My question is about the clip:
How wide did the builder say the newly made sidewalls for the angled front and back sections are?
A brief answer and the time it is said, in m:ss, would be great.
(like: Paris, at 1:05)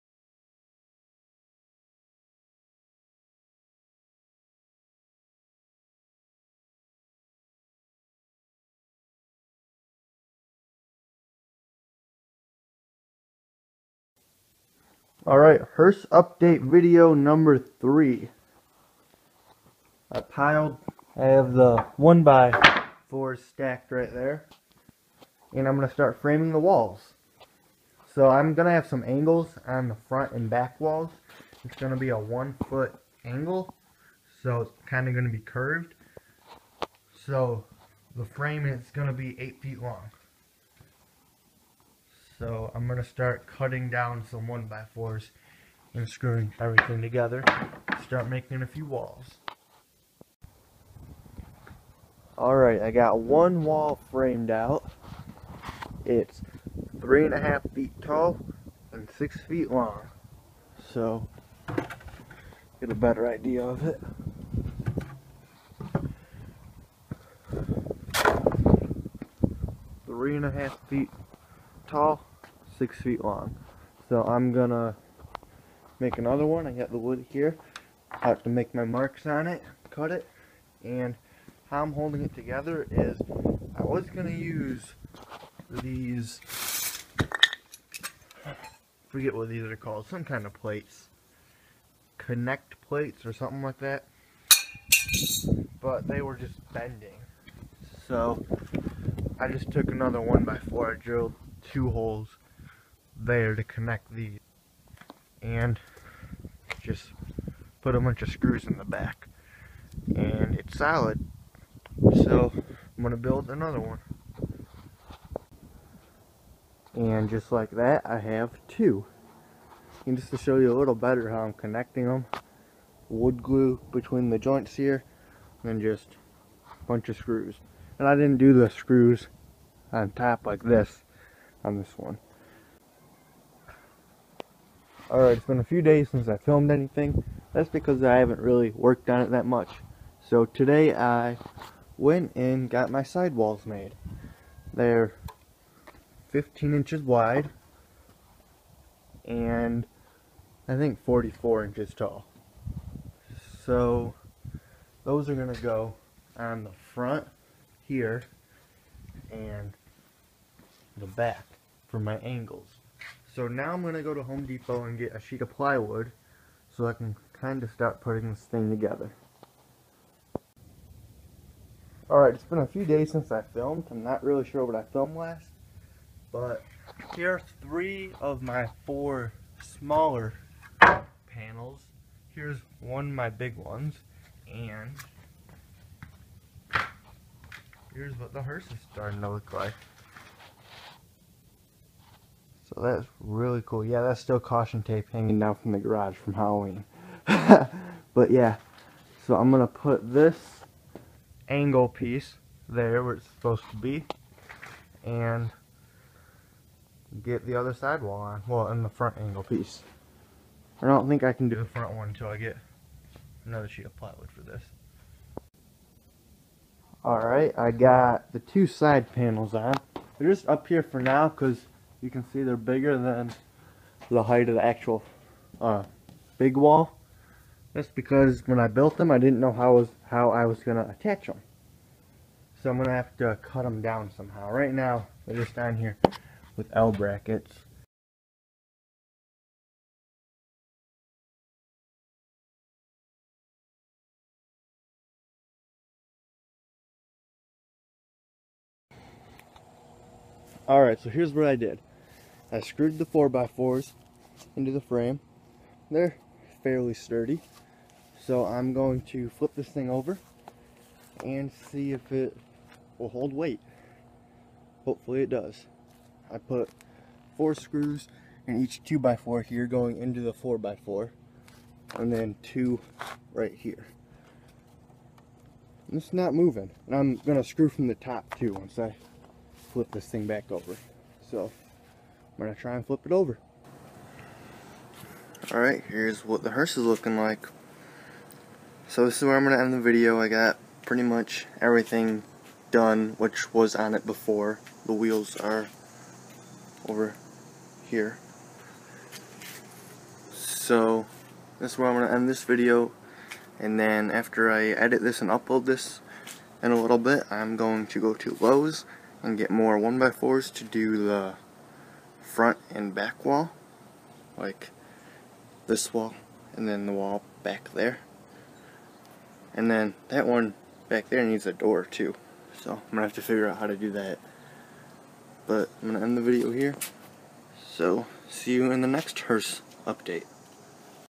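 15 inches, at 2:26.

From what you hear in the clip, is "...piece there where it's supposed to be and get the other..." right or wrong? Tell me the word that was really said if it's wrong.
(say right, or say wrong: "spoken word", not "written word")
right.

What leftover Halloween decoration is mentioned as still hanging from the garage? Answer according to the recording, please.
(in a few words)
caution tape.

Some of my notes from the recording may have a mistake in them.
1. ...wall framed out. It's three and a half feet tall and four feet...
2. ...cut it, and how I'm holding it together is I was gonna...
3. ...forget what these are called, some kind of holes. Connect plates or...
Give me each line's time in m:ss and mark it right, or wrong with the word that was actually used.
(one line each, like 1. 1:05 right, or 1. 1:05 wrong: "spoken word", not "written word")
1. 0:53 wrong: "six", not "four"
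2. 1:19 right
3. 1:29 wrong: "plates", not "holes".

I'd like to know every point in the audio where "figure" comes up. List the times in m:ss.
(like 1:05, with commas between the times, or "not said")
5:23.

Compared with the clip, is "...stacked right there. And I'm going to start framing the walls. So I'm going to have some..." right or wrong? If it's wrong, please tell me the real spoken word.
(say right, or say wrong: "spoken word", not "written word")
right.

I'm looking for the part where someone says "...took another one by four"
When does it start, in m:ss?
1:39.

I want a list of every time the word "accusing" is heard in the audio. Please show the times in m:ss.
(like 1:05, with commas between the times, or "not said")
not said.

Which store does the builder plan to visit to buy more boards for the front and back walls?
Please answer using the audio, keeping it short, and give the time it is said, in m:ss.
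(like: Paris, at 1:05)
Lowe's, at 5:08.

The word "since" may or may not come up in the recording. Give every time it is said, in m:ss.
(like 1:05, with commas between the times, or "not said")
2:16, 2:53.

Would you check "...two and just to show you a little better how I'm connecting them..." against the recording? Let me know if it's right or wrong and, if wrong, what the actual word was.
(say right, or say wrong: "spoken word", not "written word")
right.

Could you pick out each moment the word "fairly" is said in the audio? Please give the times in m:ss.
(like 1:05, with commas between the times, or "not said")
4:16.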